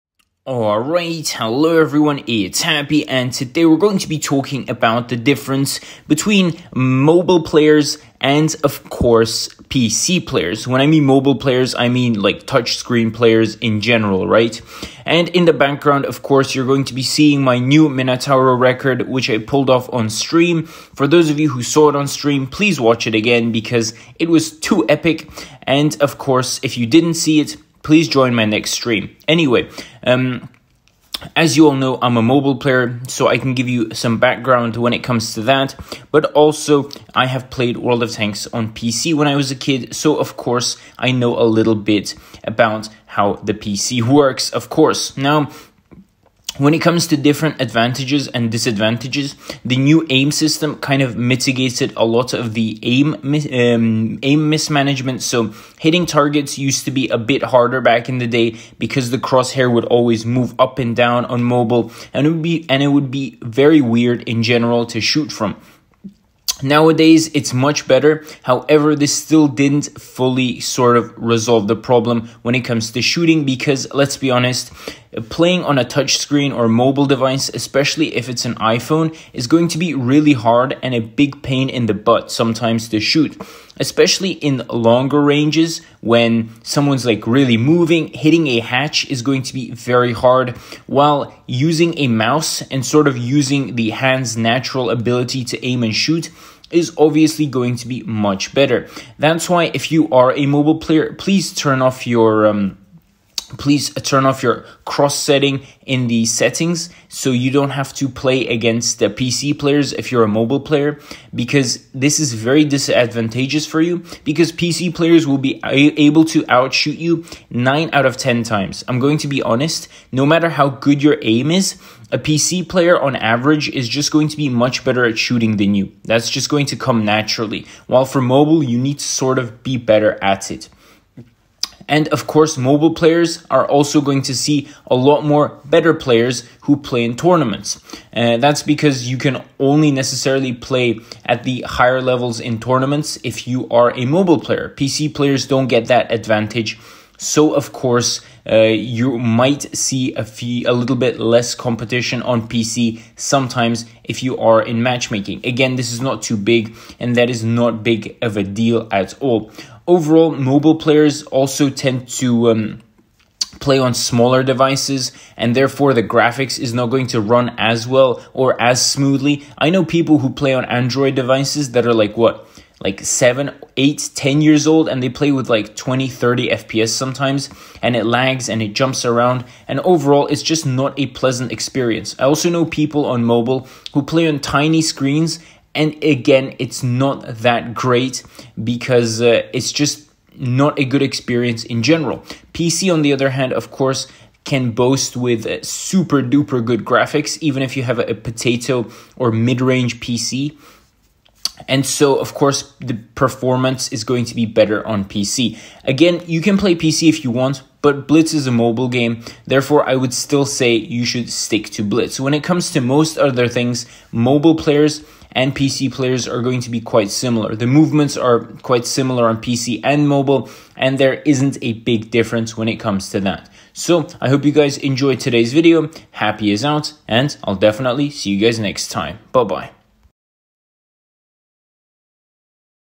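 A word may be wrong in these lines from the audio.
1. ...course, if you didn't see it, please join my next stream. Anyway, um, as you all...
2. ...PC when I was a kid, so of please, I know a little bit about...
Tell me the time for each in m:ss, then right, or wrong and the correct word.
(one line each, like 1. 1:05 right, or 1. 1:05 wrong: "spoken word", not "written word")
1. 0:26 right
2. 0:38 wrong: "course", not "please".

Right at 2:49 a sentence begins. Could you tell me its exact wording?
I know people who play on Android devices that are like what?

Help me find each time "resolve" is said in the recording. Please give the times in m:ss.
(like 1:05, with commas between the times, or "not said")
1:11.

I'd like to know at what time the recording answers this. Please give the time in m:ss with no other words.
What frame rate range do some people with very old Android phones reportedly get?
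2:55.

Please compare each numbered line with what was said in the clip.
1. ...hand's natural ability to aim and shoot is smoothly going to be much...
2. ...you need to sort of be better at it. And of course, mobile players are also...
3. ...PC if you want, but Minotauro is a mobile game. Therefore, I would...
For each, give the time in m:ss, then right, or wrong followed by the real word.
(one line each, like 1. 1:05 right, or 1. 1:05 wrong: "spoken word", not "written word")
1. 1:33 wrong: "obviously", not "smoothly"
2. 2:08 right
3. 3:26 wrong: "Blitz", not "Minotauro".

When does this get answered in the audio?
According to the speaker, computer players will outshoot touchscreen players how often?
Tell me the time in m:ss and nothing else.
1:57.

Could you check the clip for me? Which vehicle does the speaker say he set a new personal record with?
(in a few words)
Minotauro.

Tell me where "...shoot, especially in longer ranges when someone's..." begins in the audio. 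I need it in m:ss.
1:23.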